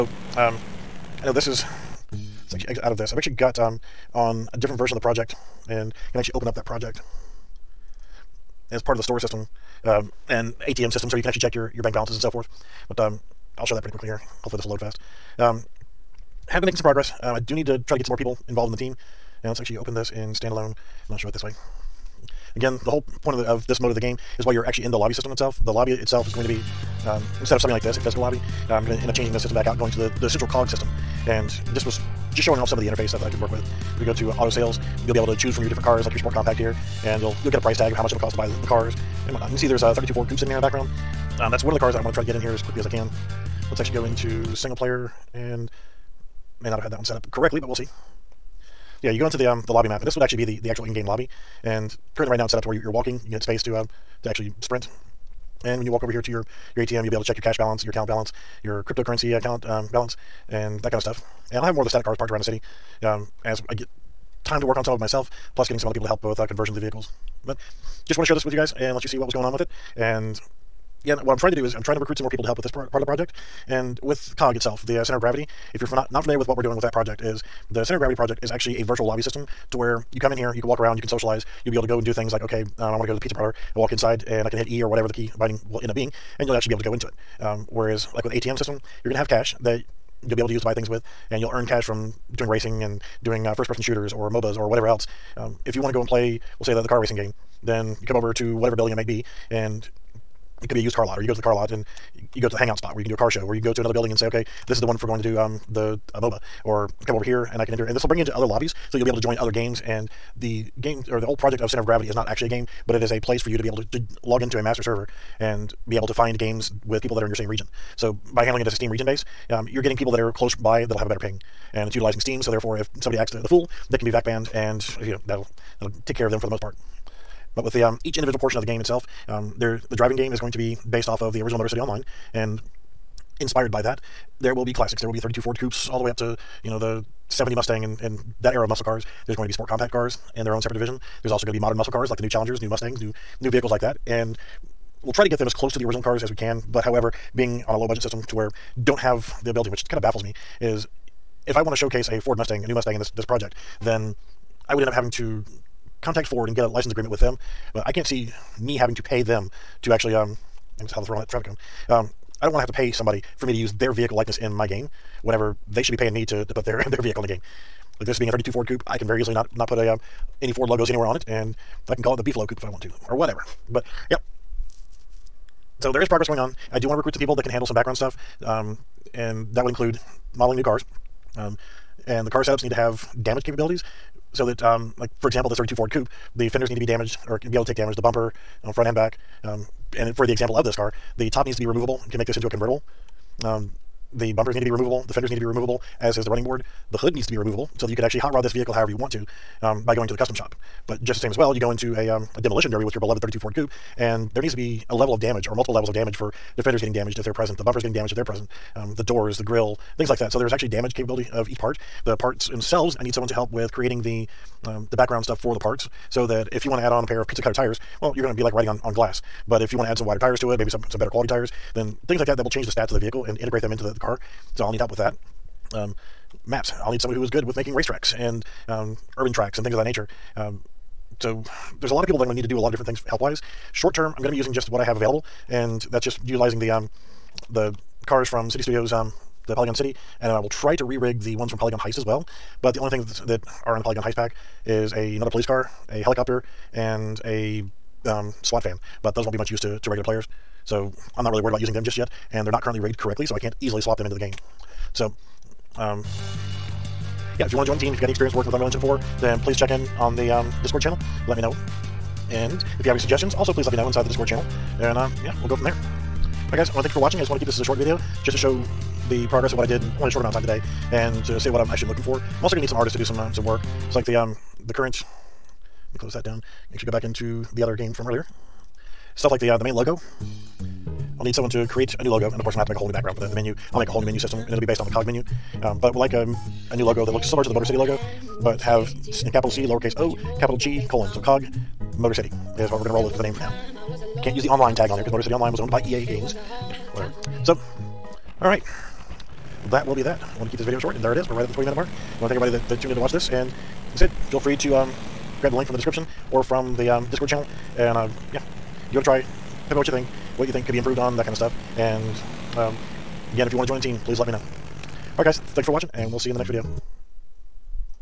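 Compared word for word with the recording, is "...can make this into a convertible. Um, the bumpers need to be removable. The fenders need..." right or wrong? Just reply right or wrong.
right.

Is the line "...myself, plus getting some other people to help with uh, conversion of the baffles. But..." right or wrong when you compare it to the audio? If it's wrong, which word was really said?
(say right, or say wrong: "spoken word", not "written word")
wrong: "vehicles", not "baffles".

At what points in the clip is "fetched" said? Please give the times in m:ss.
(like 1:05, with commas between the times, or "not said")
not said.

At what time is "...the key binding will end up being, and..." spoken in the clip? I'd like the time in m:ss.
1:25.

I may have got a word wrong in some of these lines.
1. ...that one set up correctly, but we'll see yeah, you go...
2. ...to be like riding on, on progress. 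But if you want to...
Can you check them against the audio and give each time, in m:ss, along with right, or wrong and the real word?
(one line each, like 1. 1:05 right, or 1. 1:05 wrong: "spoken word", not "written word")
1. 0:46 right
2. 3:38 wrong: "glass", not "progress".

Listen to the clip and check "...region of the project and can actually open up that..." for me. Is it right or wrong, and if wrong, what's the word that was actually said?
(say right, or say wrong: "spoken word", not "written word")
wrong: "version", not "region".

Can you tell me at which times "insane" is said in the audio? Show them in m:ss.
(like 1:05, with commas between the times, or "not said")
not said.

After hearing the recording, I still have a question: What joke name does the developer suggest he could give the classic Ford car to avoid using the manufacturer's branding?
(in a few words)
Beefalo Coupe.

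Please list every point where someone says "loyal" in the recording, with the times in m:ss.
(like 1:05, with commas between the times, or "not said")
not said.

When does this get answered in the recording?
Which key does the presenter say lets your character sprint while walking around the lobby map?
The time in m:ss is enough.
0:53.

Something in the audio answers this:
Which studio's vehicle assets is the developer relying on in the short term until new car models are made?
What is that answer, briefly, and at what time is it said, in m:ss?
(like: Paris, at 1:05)
Synty Studios, at 3:58.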